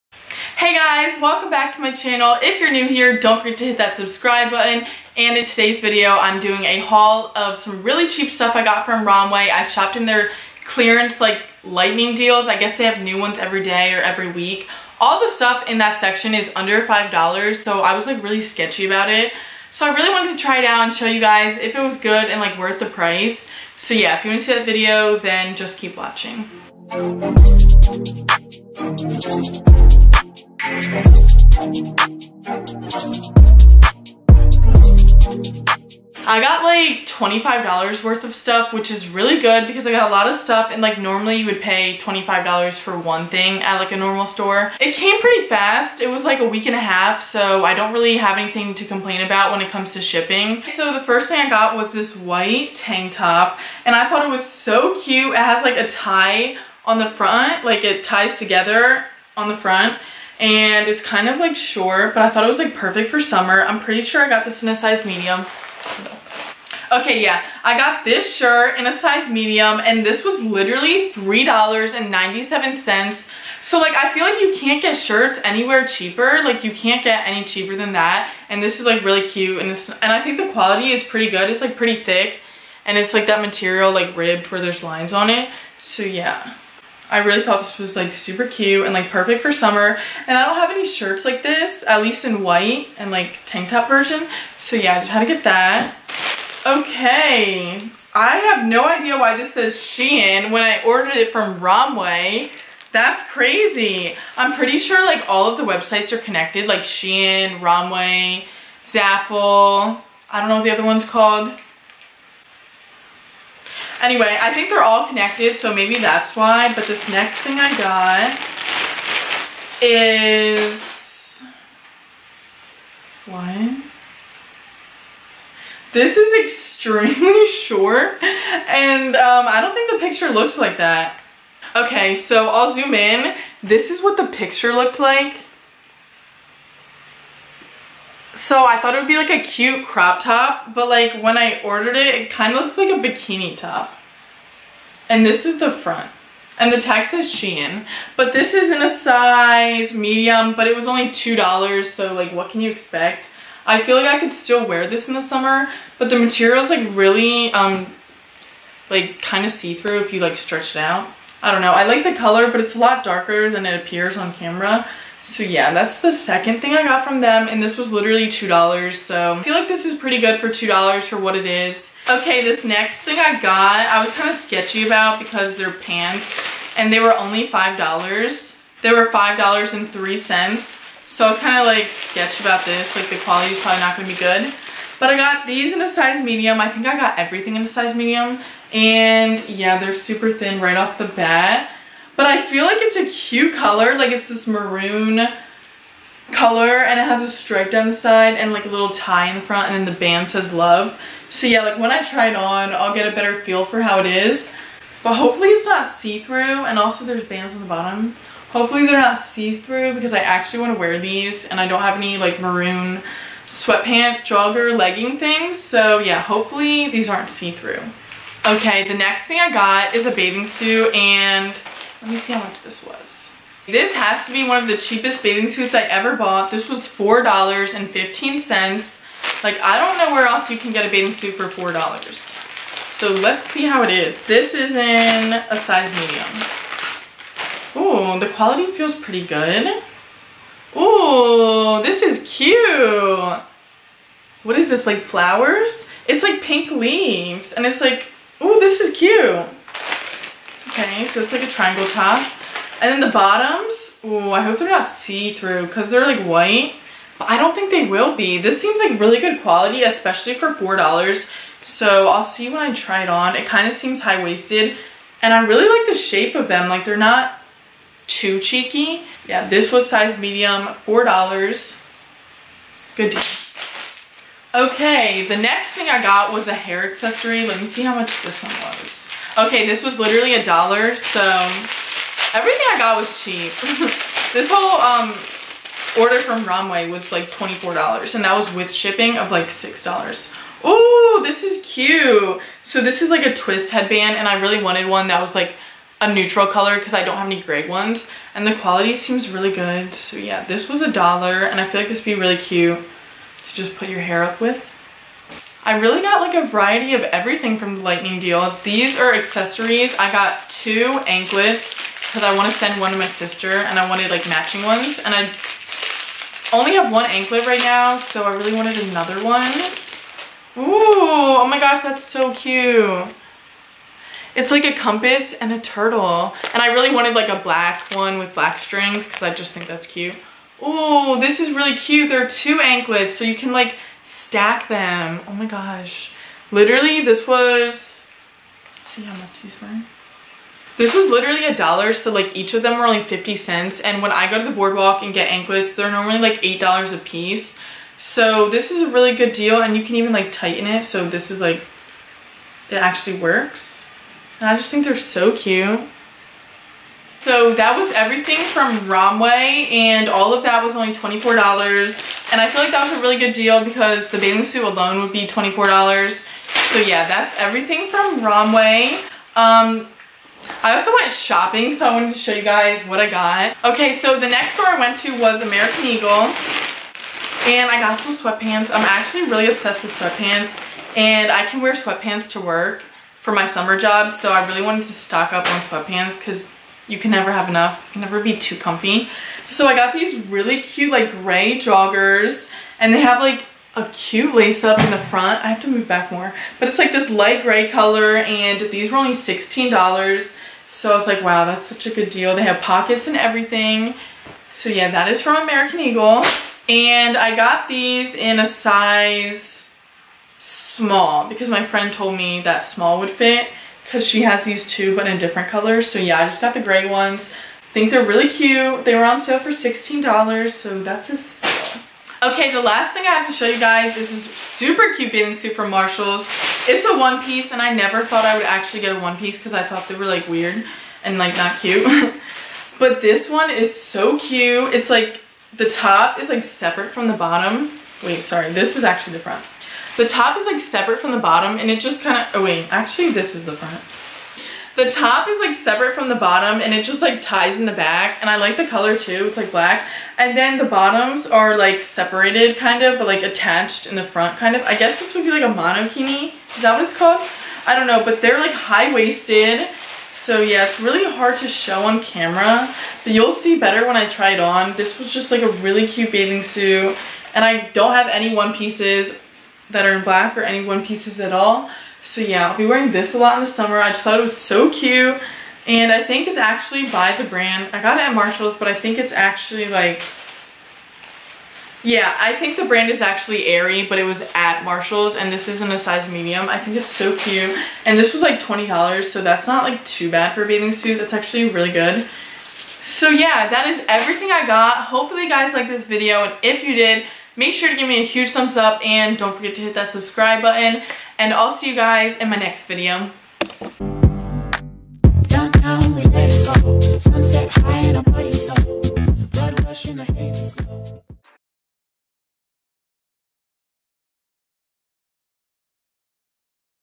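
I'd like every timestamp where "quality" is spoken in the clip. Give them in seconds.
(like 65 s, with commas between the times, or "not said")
80 s, 183 s, 238 s, 259 s, 298 s.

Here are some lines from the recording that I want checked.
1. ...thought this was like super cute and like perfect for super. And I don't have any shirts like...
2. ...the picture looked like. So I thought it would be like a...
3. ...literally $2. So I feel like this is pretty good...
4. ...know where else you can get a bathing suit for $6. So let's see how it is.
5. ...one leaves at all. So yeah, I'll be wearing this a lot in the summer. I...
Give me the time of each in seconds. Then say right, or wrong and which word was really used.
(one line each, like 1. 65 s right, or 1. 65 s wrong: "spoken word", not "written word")
1. 87 s wrong: "summer", not "super"
2. 134 s right
3. 167 s right
4. 229 s wrong: "4", not "6"
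5. 470 s wrong: "pieces", not "leaves".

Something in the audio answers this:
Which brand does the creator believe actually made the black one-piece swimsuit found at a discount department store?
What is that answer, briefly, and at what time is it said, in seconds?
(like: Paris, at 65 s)
Aerie, at 483 s.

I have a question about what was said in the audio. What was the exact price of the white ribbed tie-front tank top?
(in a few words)
$3.97.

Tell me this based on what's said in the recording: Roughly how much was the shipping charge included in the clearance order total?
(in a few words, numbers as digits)
$6.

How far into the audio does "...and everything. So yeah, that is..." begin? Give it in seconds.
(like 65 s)
403 s.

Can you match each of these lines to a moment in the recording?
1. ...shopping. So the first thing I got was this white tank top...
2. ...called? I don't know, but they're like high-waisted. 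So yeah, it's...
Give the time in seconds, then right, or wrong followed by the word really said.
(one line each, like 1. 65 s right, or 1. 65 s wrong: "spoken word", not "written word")
1. 50 s wrong: "shipping", not "shopping"
2. 456 s right.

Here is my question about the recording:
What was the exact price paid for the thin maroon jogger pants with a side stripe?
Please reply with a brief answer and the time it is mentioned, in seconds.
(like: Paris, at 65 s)
$5.03, at 179 s.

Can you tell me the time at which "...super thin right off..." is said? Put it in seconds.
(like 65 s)
189 s.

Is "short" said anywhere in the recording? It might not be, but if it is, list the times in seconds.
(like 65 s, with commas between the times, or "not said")
61 s, 127 s.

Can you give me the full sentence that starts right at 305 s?
I really got like a variety of everything from the Lightning deals.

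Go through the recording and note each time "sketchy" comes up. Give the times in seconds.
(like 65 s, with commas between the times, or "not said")
18 s, 174 s, 181 s.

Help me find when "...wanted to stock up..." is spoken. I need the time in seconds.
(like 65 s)
384 s.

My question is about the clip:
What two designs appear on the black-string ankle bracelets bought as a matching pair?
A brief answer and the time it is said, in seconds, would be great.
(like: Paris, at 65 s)
a compass and a turtle, at 324 s.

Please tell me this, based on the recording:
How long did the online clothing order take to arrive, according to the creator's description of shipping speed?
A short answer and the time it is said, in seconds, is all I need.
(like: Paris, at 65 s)
a week and a half, at 46 s.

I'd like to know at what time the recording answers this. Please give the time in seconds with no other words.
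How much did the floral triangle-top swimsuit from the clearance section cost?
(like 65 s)
226 s.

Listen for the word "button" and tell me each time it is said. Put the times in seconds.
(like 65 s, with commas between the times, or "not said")
4 s, 500 s.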